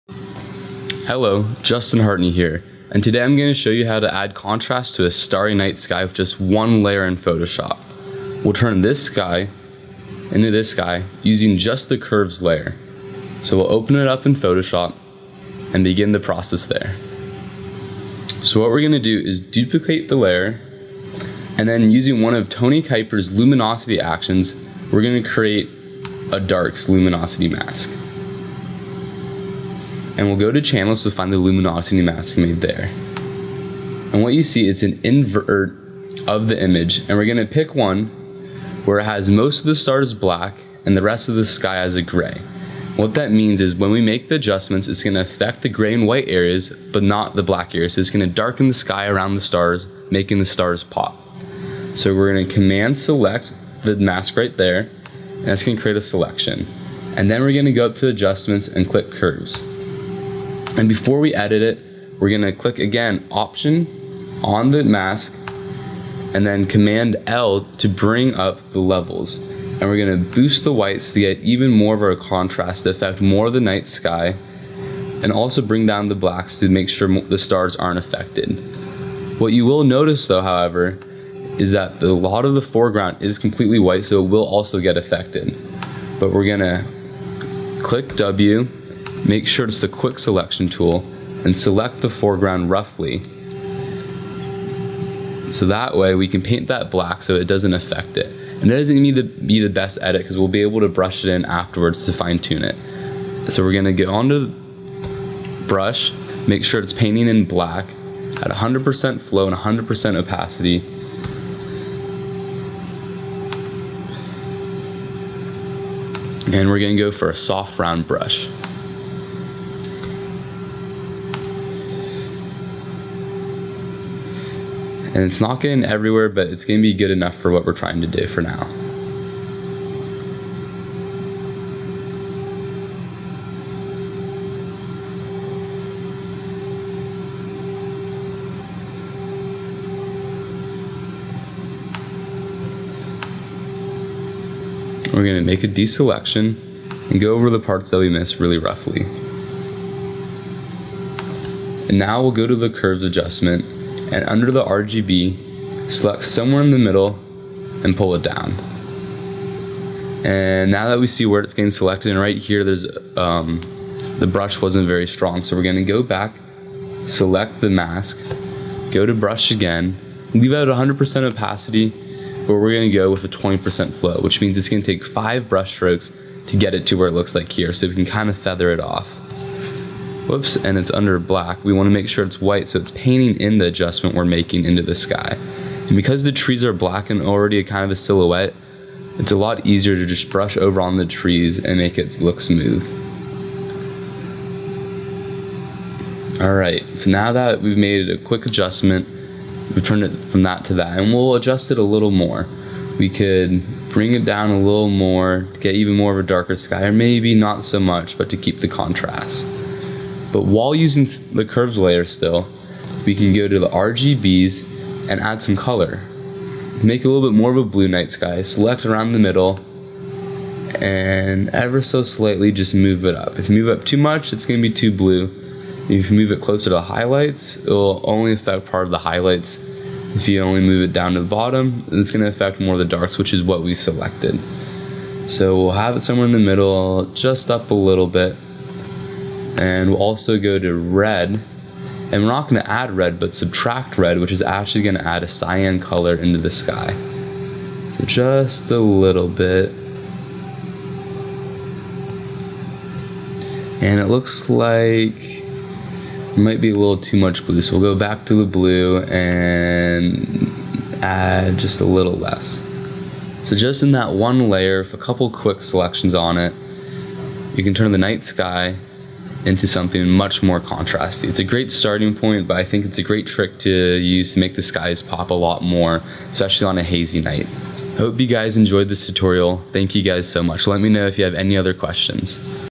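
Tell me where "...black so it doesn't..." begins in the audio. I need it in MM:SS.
01:36.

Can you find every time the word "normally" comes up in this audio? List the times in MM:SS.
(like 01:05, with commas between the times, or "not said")
not said.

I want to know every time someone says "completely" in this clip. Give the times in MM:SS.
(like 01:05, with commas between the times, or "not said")
01:23.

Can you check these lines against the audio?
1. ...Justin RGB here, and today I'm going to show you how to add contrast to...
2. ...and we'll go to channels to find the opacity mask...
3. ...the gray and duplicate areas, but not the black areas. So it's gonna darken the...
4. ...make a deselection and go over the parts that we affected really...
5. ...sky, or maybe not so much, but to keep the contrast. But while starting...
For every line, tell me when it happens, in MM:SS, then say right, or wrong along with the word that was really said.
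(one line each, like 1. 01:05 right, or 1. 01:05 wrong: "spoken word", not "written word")
1. 00:01 wrong: "Hartney", not "RGB"
2. 00:30 wrong: "luminosity", not "opacity"
3. 00:45 wrong: "white", not "duplicate"
4. 02:25 wrong: "missed", not "affected"
5. 03:26 wrong: "using", not "starting".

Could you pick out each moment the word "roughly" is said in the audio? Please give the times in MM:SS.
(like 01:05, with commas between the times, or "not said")
01:32, 02:28.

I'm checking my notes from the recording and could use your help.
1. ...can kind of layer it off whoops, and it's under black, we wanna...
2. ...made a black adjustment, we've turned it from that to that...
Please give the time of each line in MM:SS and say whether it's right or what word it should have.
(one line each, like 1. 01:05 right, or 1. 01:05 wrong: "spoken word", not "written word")
1. 02:57 wrong: "feather", not "layer"
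2. 03:17 wrong: "quick", not "black".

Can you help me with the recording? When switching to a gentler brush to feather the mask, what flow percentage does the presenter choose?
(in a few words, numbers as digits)
20%.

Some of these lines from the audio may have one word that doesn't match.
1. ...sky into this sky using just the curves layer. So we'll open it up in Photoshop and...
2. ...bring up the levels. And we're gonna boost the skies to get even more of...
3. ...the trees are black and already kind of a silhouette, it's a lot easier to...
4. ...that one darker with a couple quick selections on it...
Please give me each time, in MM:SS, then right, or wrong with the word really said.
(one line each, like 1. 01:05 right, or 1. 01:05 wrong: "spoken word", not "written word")
1. 00:09 right
2. 01:07 wrong: "whites", not "skies"
3. 03:06 right
4. 04:23 wrong: "layer", not "darker".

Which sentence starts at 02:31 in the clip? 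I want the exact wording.
And now we'll go to the curves adjustment and under the RGB, select somewhere in the middle and pull it down.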